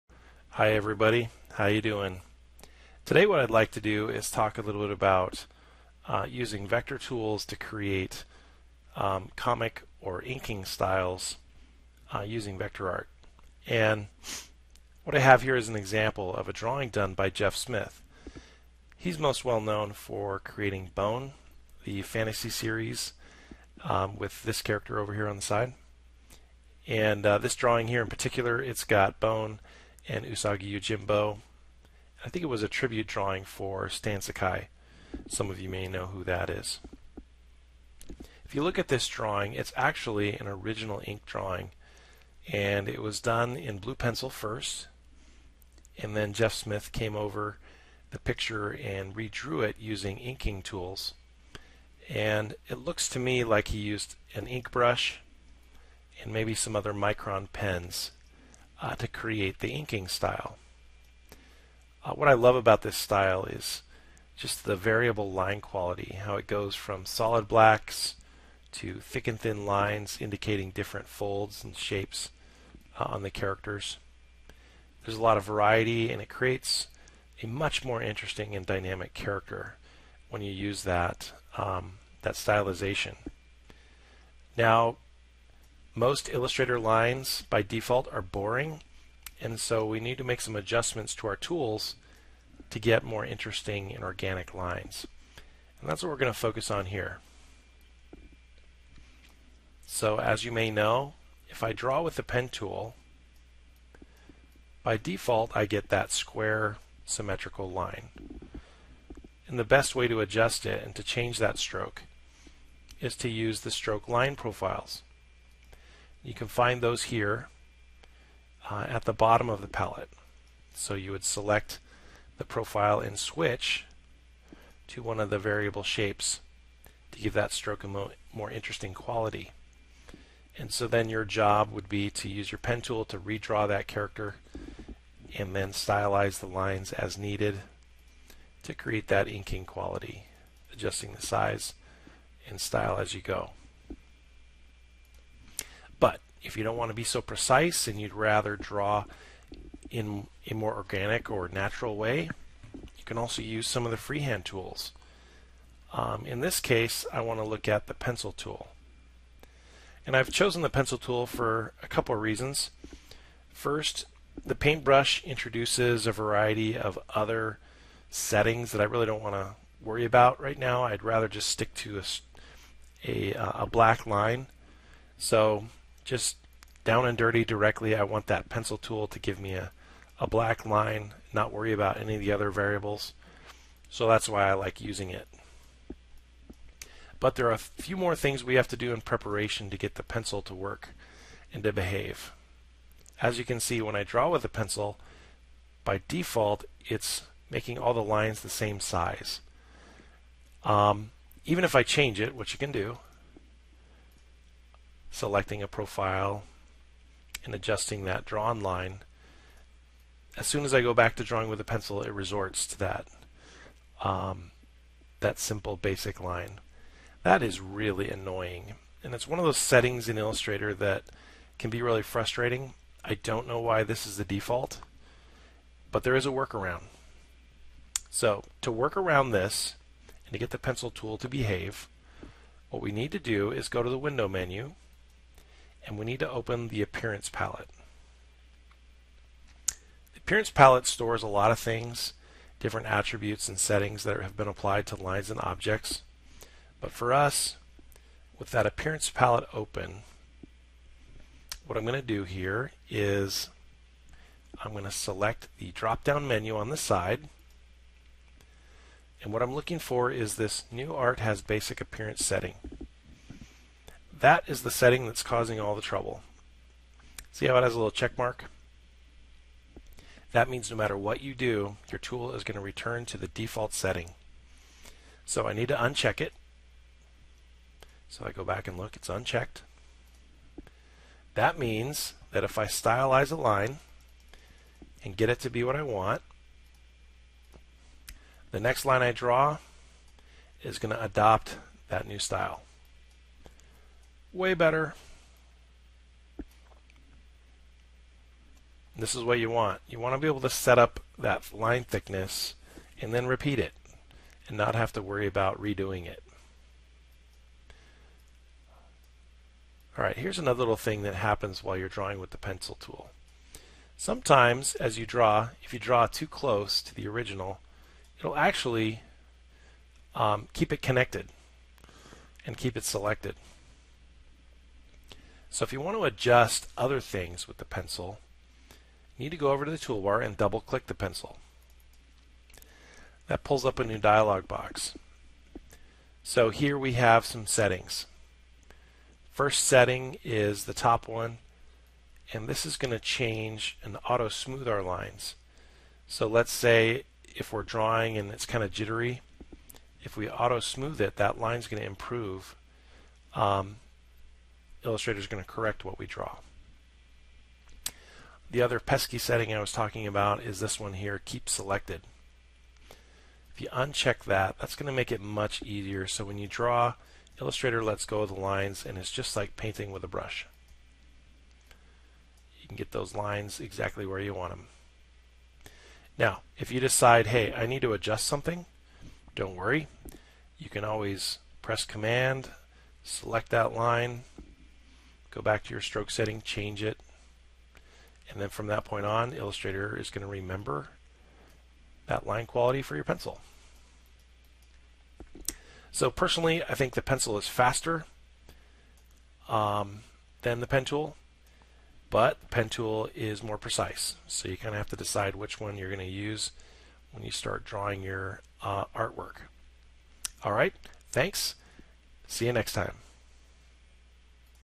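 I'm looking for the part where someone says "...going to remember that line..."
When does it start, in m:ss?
6:30.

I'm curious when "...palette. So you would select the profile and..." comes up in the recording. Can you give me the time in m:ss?
1:59.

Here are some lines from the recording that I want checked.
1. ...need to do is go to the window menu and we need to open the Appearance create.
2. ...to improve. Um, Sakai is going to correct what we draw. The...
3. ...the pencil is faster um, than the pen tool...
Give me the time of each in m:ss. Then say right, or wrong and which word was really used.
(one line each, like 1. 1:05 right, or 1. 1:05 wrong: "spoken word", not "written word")
1. 3:52 wrong: "palette", not "create"
2. 5:51 wrong: "Illustrator", not "Sakai"
3. 6:36 right.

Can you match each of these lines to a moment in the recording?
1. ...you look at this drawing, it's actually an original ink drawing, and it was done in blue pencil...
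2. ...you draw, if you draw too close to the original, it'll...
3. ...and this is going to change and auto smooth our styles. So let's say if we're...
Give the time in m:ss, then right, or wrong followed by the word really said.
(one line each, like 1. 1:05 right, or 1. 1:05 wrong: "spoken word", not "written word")
1. 0:38 right
2. 5:14 right
3. 5:42 wrong: "lines", not "styles".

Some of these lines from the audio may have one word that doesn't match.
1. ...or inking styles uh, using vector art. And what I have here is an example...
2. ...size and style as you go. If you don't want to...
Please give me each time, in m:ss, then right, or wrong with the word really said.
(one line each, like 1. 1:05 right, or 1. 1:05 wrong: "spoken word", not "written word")
1. 0:10 right
2. 2:21 right.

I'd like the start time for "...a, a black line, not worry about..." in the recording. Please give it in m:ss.
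2:59.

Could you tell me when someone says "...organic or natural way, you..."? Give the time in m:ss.
2:30.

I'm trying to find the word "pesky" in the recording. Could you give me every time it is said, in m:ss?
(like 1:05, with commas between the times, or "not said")
5:58.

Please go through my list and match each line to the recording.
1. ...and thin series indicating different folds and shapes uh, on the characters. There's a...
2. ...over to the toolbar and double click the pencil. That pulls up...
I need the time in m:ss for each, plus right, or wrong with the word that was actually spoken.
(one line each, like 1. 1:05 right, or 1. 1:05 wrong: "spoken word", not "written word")
1. 1:09 wrong: "lines", not "series"
2. 5:29 right.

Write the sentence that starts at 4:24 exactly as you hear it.
That is the setting that's causing all the trouble.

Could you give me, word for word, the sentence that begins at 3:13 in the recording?
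As you can see, when I draw with a pencil, by default, it's making all the lines the same size.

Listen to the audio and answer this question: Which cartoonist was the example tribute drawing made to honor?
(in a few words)
Stan Sakai.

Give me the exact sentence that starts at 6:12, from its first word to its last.
You can get those lines exactly where you want them.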